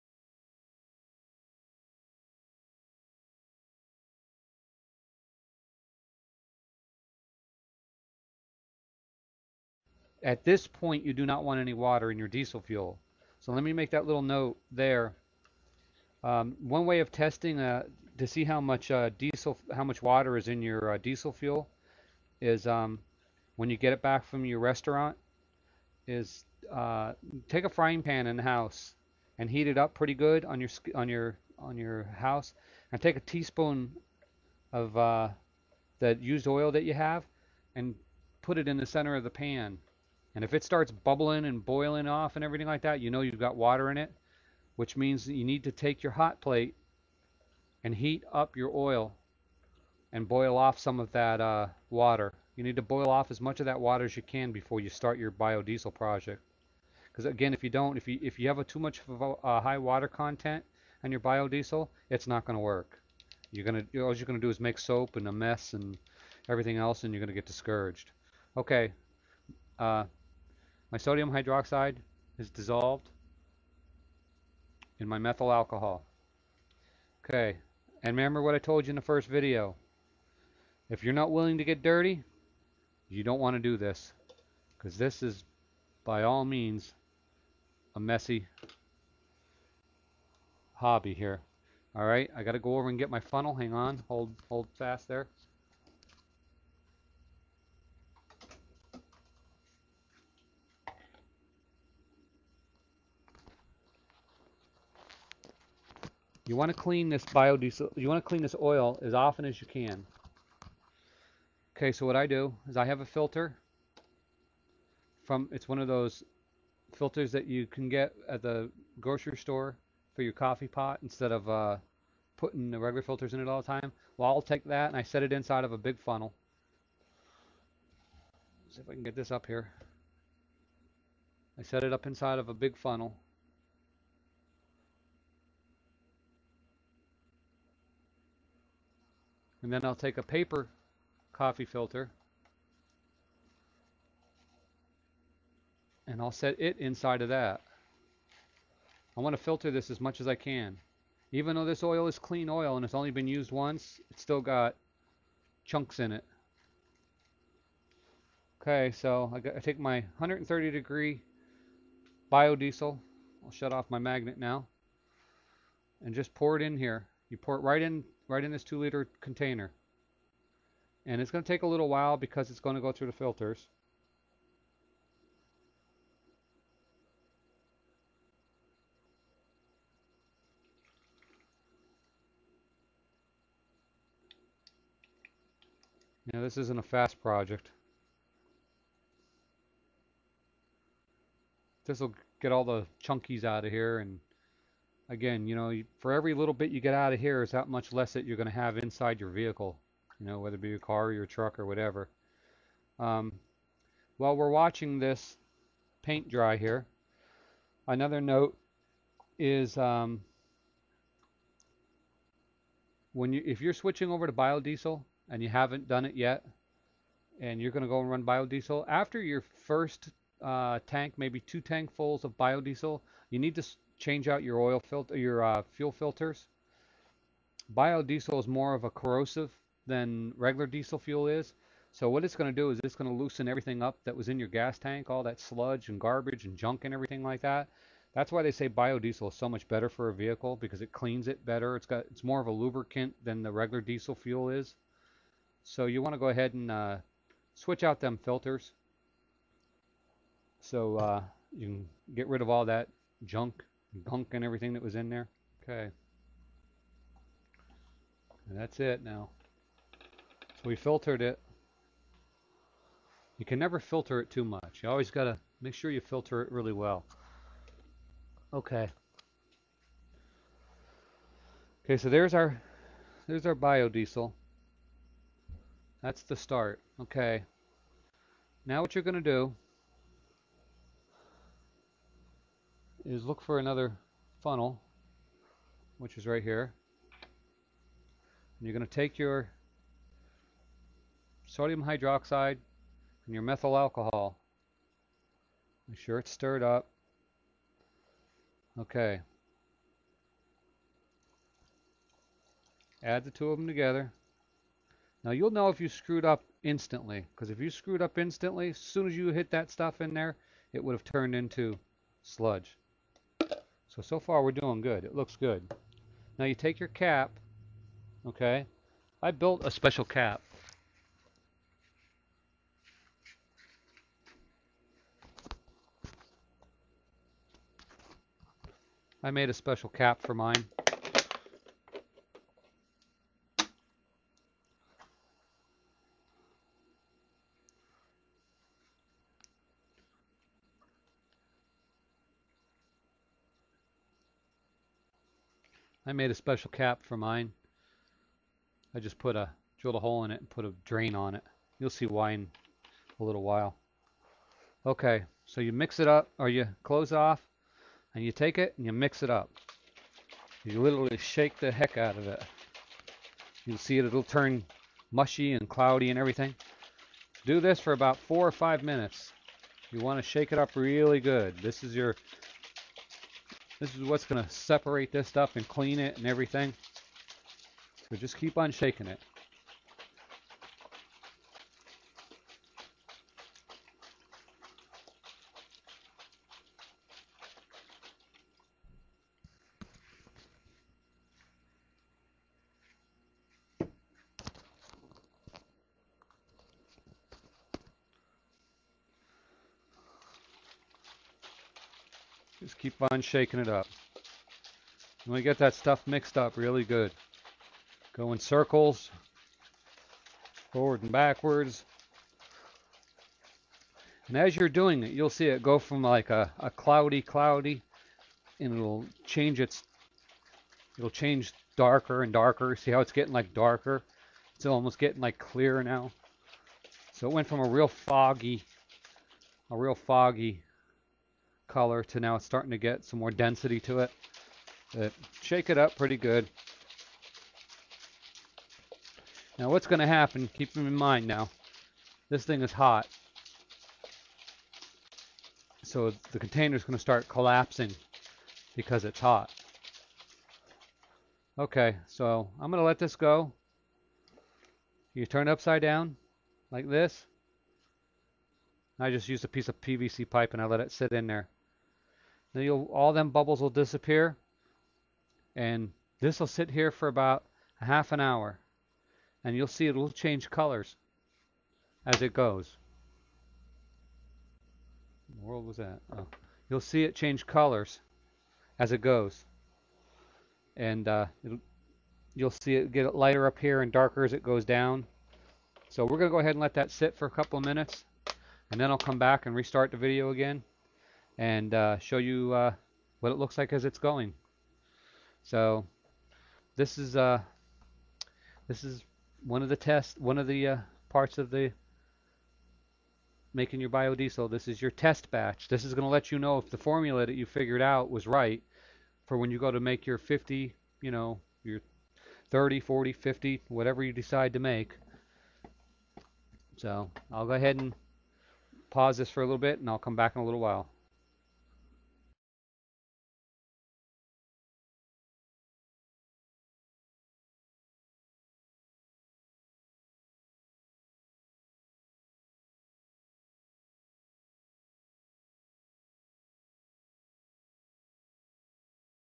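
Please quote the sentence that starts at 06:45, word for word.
And we get that stuff mixed up really good.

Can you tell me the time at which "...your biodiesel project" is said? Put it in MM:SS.
00:55.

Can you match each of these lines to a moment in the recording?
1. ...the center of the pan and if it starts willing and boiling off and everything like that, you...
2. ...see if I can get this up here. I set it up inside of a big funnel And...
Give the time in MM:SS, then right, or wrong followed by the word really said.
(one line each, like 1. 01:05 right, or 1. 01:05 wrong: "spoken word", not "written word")
1. 00:38 wrong: "bubbling", not "willing"
2. 02:08 right.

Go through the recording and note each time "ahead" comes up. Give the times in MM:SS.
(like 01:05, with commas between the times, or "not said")
04:06, 08:06, 08:37.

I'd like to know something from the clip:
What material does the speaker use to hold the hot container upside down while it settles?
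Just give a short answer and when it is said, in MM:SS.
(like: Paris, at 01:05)
PVC pipe, at 07:39.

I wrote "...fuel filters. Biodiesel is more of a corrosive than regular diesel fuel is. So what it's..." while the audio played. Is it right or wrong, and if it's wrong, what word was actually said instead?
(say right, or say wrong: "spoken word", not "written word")
right.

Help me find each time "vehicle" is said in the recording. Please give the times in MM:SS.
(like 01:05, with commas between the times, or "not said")
03:19, 04:00.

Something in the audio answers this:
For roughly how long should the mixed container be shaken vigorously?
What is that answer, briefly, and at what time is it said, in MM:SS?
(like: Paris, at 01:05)
four or five minutes, at 06:08.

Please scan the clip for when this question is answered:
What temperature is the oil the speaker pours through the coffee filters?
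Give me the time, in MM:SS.
02:40.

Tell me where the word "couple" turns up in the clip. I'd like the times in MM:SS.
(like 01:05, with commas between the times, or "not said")
08:07.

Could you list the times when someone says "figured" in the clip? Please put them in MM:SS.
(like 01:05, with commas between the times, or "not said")
08:27.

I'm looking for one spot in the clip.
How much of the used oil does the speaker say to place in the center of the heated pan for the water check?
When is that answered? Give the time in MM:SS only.
00:33.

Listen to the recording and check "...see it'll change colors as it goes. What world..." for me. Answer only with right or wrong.
right.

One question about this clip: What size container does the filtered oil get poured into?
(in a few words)
2 liter.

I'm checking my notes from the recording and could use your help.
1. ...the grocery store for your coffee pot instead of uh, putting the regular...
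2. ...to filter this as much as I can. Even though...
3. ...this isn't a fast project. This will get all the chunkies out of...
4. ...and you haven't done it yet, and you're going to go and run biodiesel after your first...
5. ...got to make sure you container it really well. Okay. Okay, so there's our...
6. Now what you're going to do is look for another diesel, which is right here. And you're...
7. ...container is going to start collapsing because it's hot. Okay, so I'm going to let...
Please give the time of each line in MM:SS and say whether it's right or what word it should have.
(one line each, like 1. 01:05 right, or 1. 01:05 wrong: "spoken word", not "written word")
1. 01:58 right
2. 02:29 right
3. 03:06 right
4. 03:35 right
5. 04:25 wrong: "filter", not "container"
6. 04:38 wrong: "funnel", not "diesel"
7. 07:26 right.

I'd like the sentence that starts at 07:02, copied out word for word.
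See how it's getting like darker?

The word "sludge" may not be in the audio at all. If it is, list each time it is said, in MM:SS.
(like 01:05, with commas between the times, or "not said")
03:55, 05:12.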